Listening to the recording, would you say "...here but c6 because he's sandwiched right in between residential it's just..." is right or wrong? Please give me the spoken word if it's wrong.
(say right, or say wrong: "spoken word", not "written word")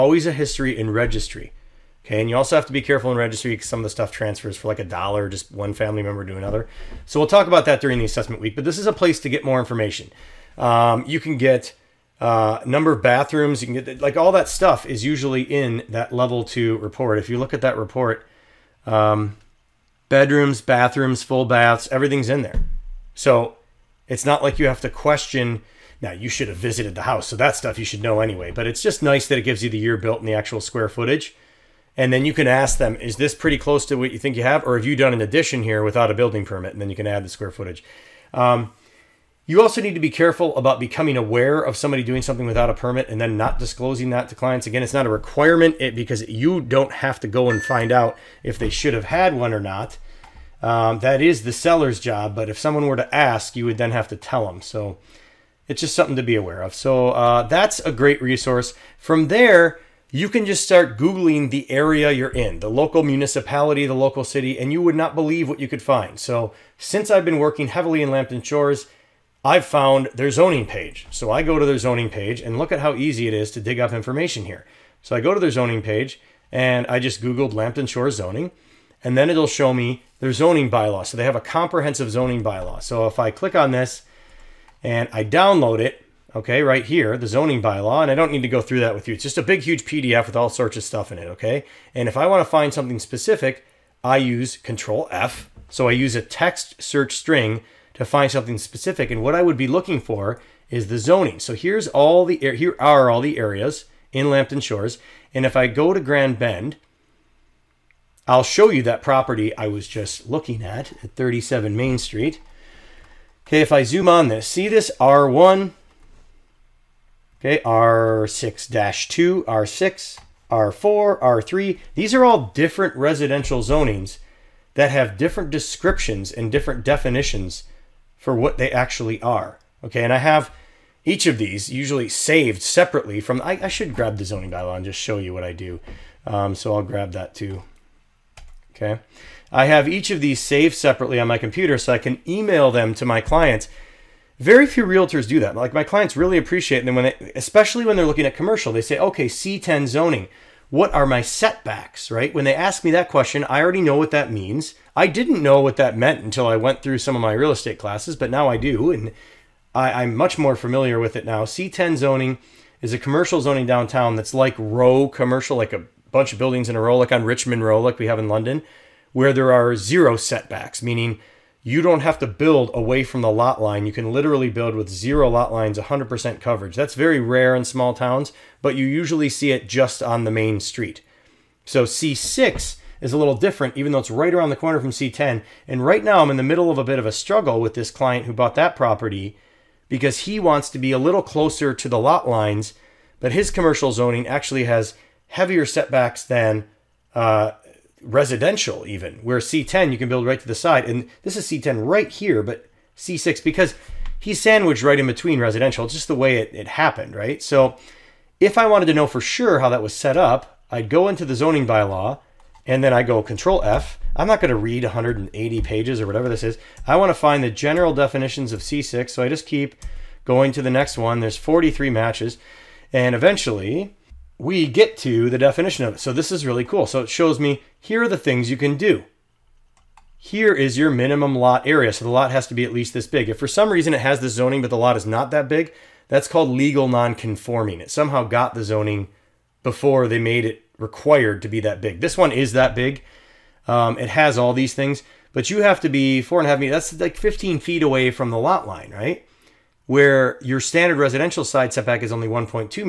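right.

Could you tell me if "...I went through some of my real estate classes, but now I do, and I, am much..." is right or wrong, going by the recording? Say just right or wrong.
right.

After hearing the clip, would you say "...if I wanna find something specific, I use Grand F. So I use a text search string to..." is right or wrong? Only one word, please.
wrong.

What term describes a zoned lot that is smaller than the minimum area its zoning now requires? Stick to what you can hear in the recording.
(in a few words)
legal non-conforming.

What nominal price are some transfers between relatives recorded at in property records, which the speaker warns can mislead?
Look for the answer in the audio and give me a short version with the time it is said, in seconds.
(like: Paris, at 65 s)
a dollar, at 4 s.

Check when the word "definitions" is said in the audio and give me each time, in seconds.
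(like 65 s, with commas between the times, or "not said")
126 s, 217 s, 225 s.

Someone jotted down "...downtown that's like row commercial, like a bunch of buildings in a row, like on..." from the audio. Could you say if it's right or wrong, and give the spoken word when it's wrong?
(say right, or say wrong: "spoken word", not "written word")
right.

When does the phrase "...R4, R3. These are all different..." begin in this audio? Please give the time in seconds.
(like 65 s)
120 s.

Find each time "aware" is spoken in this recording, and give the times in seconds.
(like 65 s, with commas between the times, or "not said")
41 s, 56 s.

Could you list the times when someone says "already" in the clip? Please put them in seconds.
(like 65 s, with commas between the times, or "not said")
153 s.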